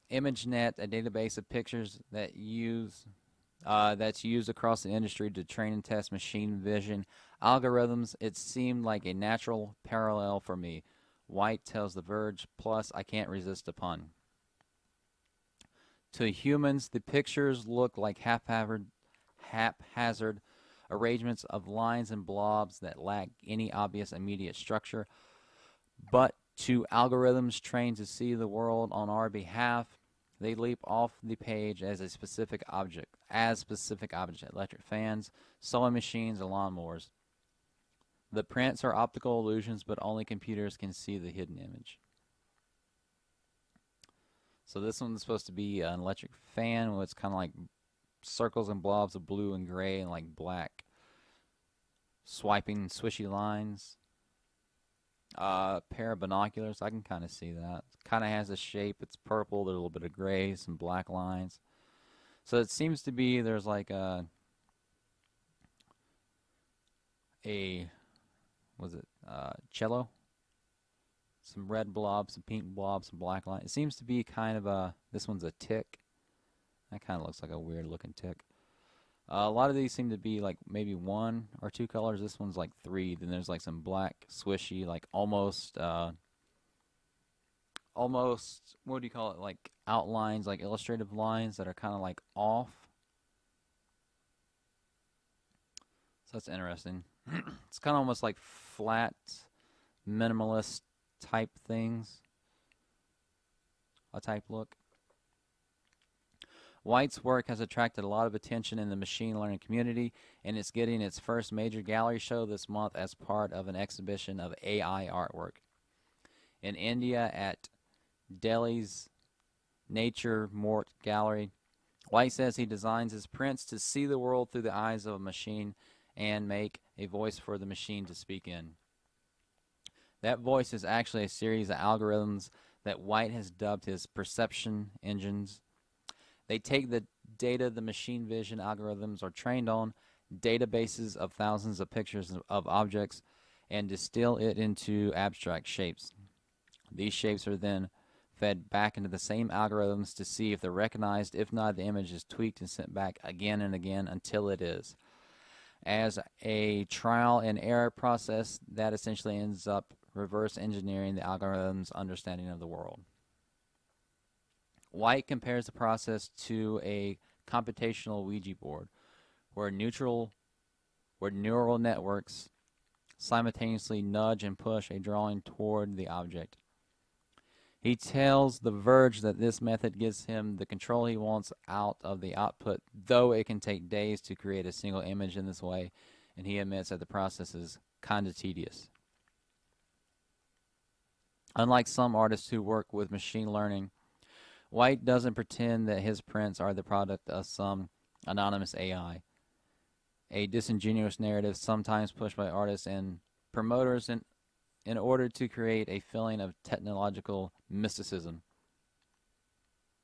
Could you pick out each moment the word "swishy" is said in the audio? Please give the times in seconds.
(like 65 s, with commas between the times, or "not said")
52 s, 84 s.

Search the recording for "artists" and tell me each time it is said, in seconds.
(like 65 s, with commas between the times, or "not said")
192 s, 202 s.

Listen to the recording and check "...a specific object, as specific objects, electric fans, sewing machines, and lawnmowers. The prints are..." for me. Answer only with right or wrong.
right.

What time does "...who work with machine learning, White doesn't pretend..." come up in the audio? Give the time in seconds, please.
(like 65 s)
192 s.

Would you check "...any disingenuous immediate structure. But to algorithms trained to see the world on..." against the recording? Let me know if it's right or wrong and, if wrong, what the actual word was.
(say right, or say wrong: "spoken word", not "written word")
wrong: "obvious", not "disingenuous".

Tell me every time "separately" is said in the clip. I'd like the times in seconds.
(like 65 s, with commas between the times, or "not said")
not said.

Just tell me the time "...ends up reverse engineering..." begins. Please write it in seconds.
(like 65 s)
159 s.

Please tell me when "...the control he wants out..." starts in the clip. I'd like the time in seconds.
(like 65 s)
180 s.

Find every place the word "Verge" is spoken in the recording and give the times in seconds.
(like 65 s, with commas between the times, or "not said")
12 s, 178 s.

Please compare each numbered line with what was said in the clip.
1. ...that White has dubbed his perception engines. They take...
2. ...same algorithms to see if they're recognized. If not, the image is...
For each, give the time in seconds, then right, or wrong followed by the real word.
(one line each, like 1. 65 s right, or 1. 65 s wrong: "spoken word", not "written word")
1. 132 s right
2. 149 s right.